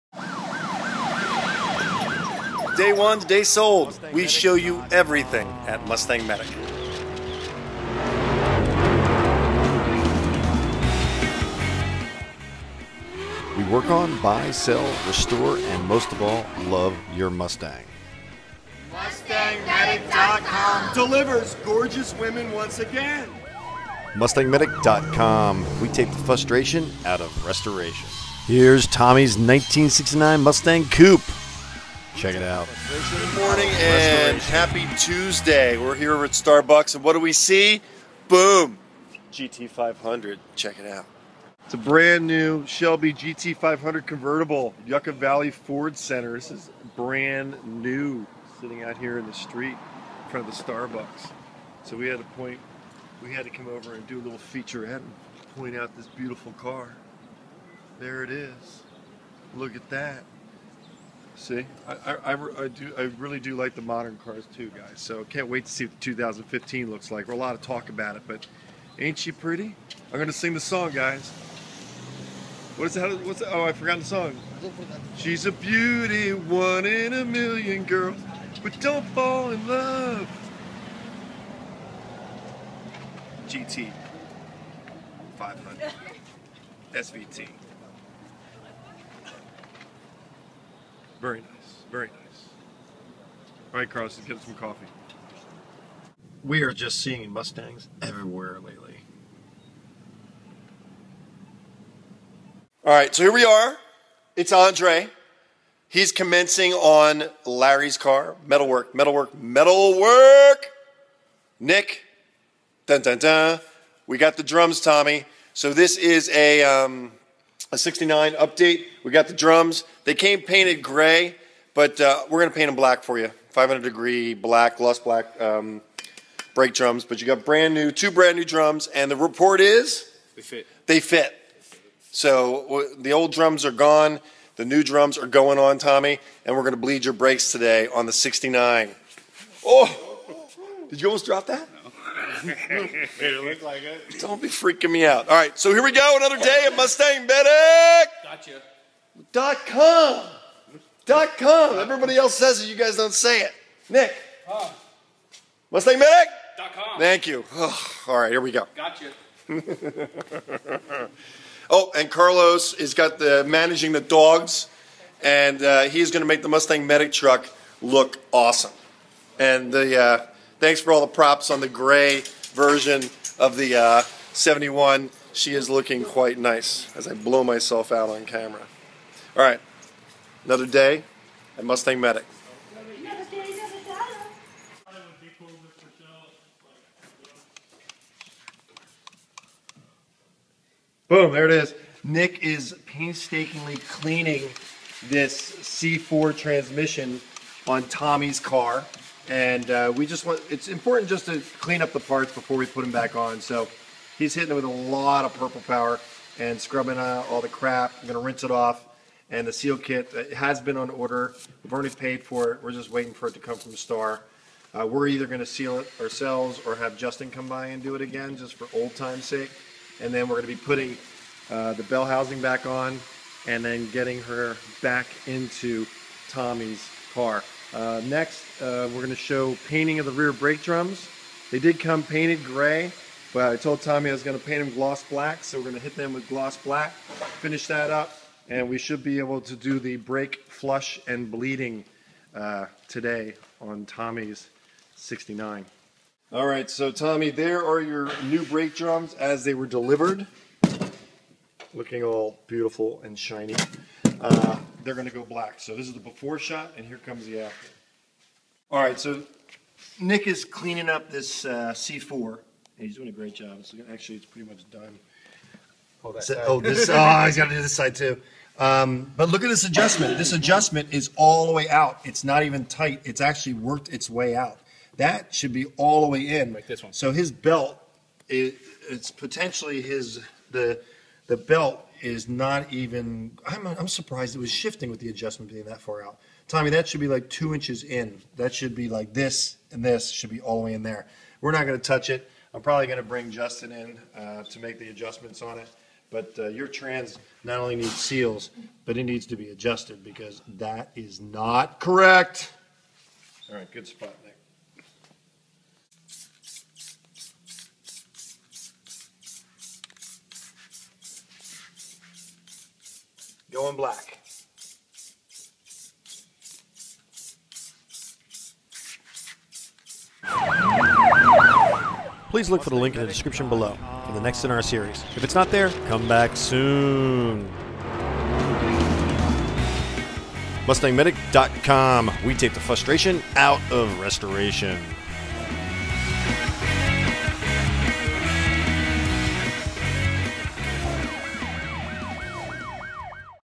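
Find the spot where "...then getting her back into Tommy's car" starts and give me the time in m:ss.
3:43.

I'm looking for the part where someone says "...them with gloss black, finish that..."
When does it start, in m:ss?
3:55.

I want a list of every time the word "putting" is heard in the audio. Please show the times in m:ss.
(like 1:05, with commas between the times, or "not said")
3:40.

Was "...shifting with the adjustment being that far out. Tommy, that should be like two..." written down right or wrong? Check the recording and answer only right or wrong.
right.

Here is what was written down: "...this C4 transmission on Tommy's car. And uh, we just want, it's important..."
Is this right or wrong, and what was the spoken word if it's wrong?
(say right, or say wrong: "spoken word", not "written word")
right.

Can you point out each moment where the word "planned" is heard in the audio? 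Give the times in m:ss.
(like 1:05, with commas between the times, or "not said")
not said.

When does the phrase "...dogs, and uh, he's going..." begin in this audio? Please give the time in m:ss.
2:44.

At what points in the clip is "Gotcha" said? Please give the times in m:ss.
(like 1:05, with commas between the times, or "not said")
2:28, 2:38.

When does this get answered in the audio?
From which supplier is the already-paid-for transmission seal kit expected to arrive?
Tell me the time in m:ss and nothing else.
3:33.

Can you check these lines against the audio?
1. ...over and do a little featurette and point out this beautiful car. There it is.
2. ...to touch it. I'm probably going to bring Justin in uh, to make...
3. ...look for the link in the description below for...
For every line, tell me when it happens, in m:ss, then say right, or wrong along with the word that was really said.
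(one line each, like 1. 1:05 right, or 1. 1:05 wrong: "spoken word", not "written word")
1. 0:53 right
2. 4:51 right
3. 5:22 right.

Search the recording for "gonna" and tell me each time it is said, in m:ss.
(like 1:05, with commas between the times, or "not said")
1:10, 3:28, 3:35, 3:40.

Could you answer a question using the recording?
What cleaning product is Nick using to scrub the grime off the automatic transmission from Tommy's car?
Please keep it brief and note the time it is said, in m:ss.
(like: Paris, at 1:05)
Purple Power, at 3:25.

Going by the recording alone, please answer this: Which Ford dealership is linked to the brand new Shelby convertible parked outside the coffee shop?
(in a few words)
Yucca Valley Ford Center.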